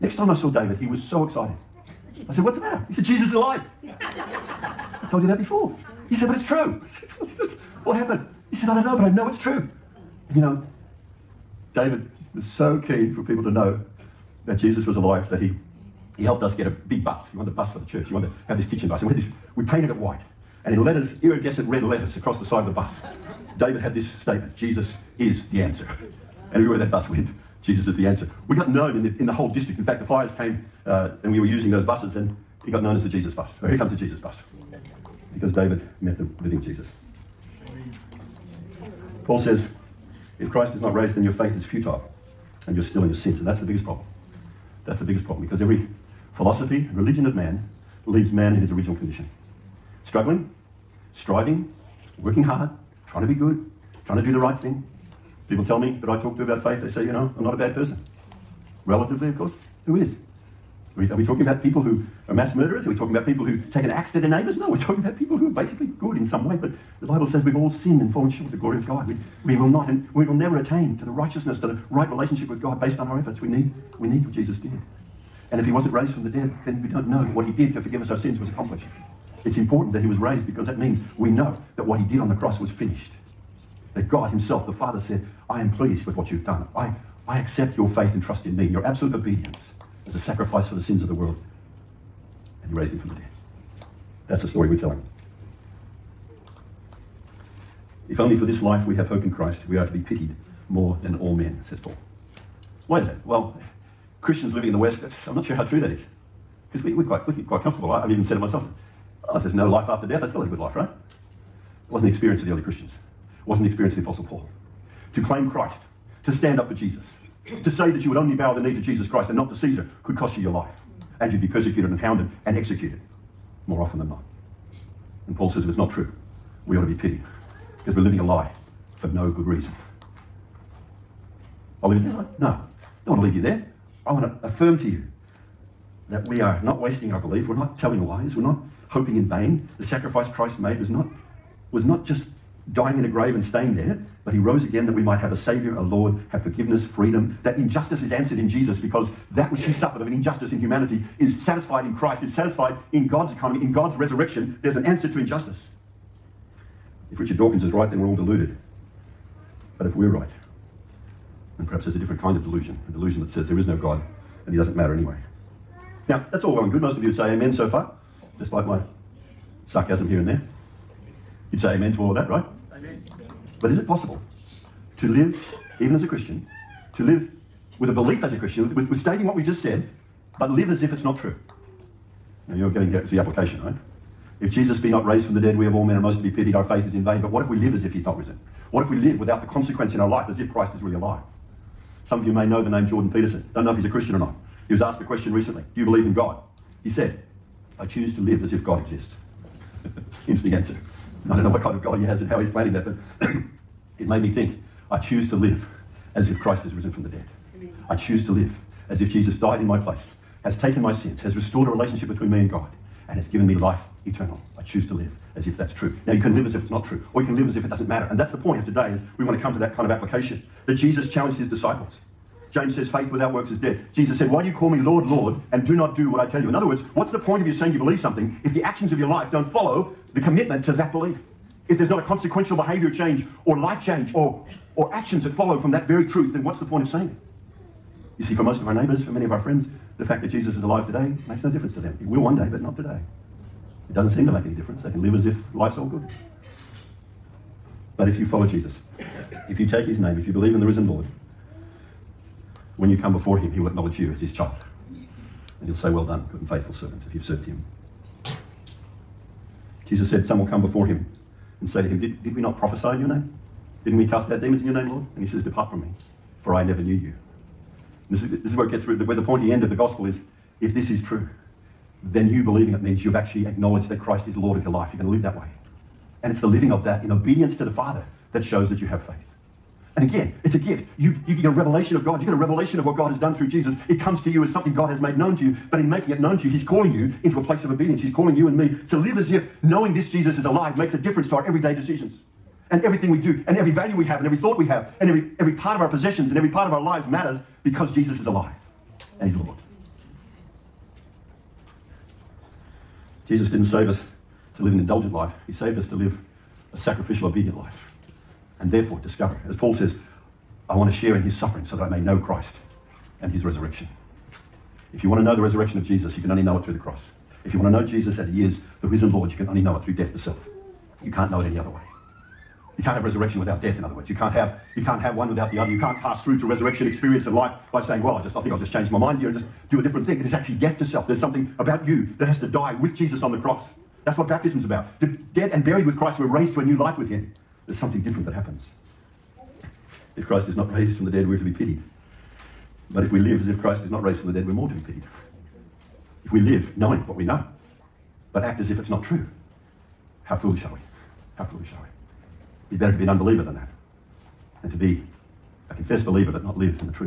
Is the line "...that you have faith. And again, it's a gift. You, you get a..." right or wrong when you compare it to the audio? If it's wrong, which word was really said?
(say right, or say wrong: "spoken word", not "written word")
right.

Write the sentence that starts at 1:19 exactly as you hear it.
It's important that he was raised because that means we know that what he did on the cross was finished.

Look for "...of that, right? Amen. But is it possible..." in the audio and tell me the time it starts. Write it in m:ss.
2:52.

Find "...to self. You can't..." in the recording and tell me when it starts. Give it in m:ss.
5:20.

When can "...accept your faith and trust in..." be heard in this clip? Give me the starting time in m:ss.
1:27.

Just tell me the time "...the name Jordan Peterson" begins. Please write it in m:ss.
3:12.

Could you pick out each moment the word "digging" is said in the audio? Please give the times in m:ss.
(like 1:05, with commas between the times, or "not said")
not said.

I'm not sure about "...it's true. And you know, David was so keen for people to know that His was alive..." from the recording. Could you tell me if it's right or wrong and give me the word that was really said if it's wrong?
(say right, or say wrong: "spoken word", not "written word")
wrong: "Jesus", not "His".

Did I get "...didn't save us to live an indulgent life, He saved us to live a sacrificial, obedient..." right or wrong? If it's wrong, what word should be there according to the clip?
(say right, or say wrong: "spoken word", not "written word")
right.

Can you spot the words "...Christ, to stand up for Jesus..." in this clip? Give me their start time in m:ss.
1:55.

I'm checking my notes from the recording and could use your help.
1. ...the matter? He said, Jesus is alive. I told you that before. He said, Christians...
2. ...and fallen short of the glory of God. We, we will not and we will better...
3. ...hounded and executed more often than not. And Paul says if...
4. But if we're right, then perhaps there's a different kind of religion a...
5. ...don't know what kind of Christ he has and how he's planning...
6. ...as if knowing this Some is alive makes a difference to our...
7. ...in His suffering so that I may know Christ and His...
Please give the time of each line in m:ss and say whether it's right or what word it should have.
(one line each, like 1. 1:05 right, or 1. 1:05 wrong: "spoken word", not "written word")
1. 0:02 wrong: "But", not "Christians"
2. 1:08 wrong: "never", not "better"
3. 2:01 right
4. 2:39 wrong: "delusion", not "religion"
5. 3:21 wrong: "God", not "Christ"
6. 4:49 wrong: "Jesus", not "Some"
7. 5:11 right.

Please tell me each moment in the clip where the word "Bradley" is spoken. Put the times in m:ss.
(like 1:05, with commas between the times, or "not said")
not said.